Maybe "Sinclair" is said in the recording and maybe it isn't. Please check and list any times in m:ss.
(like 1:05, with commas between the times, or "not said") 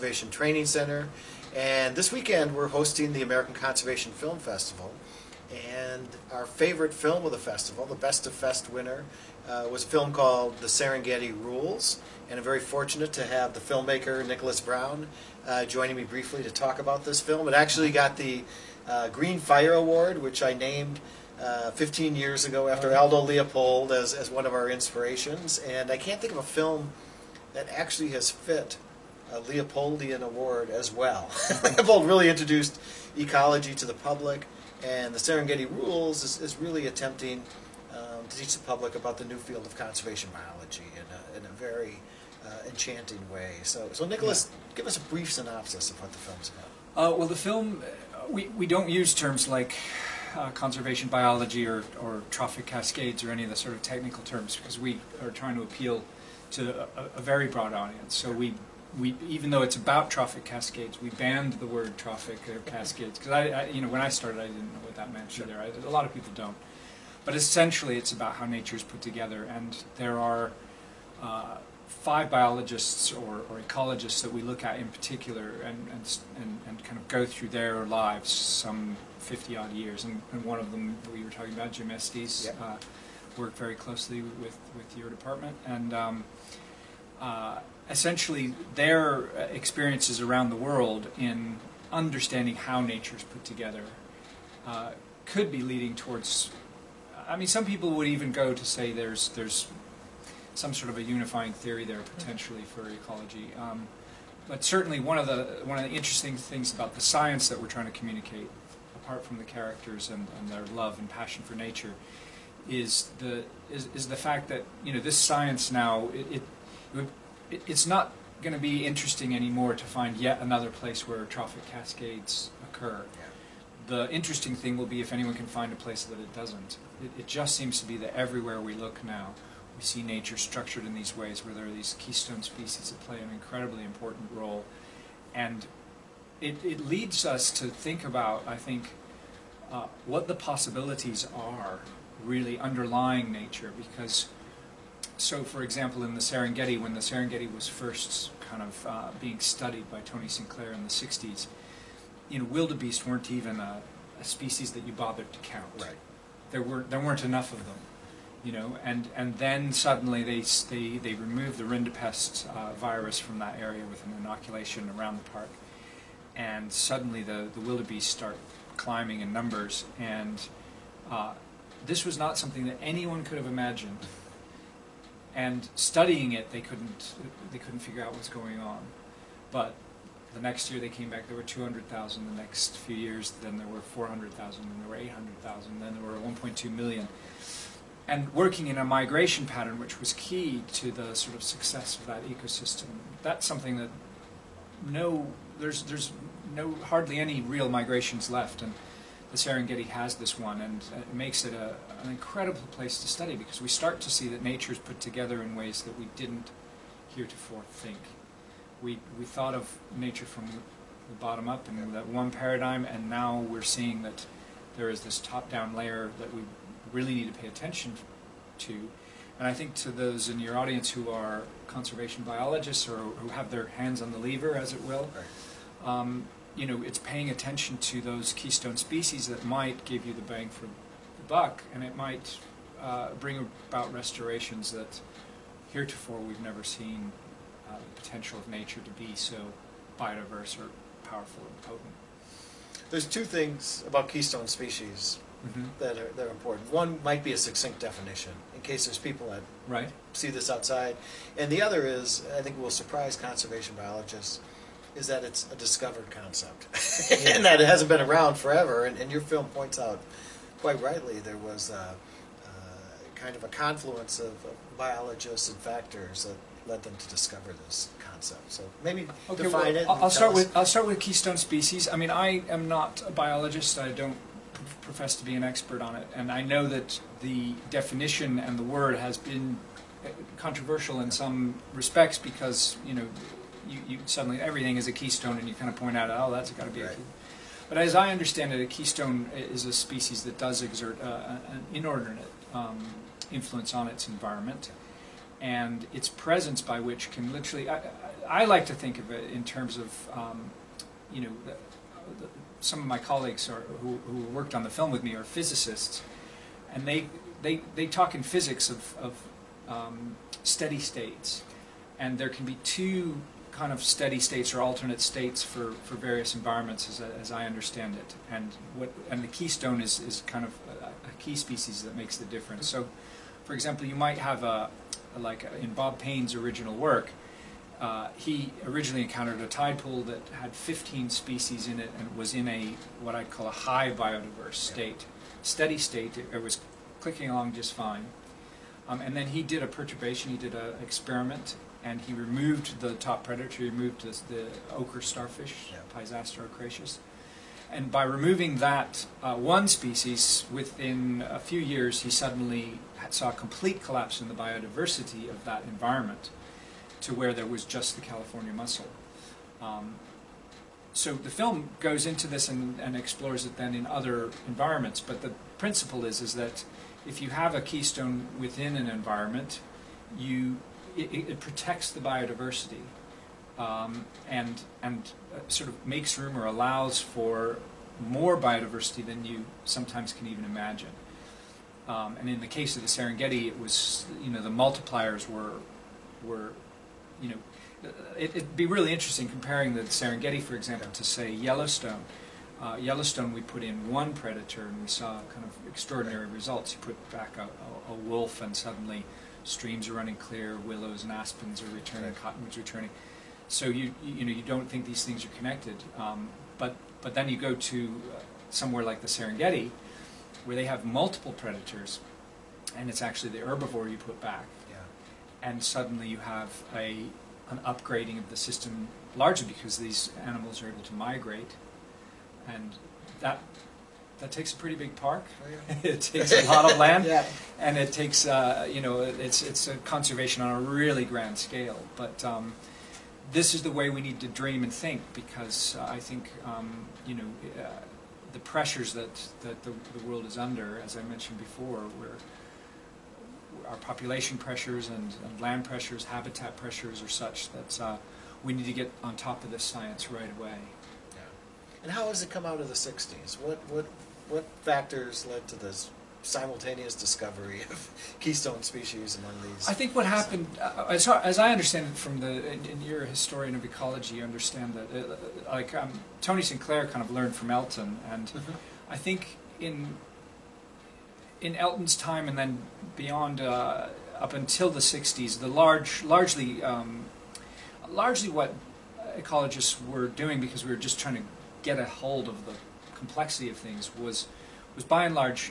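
2:30, 7:46.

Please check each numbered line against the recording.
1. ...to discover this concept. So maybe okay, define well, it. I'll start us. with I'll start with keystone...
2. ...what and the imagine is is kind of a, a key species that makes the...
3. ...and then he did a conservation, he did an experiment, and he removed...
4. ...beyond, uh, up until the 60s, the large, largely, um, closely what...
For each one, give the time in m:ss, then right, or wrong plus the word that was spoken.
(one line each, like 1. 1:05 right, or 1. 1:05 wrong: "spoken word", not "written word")
1. 4:26 right
2. 5:18 wrong: "keystone", not "imagine"
3. 5:39 wrong: "perturbation", not "conservation"
4. 7:52 wrong: "largely", not "closely".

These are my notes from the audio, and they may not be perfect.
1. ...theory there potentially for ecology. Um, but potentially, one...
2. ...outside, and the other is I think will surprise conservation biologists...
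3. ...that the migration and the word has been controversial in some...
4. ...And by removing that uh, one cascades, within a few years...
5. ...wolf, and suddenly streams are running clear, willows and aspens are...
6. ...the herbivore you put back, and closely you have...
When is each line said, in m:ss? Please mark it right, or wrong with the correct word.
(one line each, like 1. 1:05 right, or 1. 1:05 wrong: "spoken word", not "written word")
1. 1:41 wrong: "certainly", not "potentially"
2. 4:10 right
3. 4:36 wrong: "definition", not "migration"
4. 5:47 wrong: "species", not "cascades"
5. 6:37 right
6. 6:53 wrong: "suddenly", not "closely".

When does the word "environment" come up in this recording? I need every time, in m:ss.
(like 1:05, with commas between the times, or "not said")
4:54, 5:16, 5:55, 6:04, 6:08.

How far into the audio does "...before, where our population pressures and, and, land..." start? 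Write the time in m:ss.
7:21.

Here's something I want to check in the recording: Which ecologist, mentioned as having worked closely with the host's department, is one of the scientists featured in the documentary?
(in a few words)
Jim Estes.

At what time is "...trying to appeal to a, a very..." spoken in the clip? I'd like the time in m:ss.
0:55.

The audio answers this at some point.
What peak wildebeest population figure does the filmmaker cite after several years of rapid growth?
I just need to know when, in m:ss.
3:06.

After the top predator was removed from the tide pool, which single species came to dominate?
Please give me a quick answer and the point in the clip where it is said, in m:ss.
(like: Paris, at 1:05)
California mussel, at 5:58.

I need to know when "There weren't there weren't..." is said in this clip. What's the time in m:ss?
2:36.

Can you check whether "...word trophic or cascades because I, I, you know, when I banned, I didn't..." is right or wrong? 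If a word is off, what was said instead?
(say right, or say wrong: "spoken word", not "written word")
wrong: "started", not "banned".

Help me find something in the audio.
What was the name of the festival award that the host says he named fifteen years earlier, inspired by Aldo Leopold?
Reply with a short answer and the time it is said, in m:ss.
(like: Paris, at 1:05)
Green Fire Award, at 0:19.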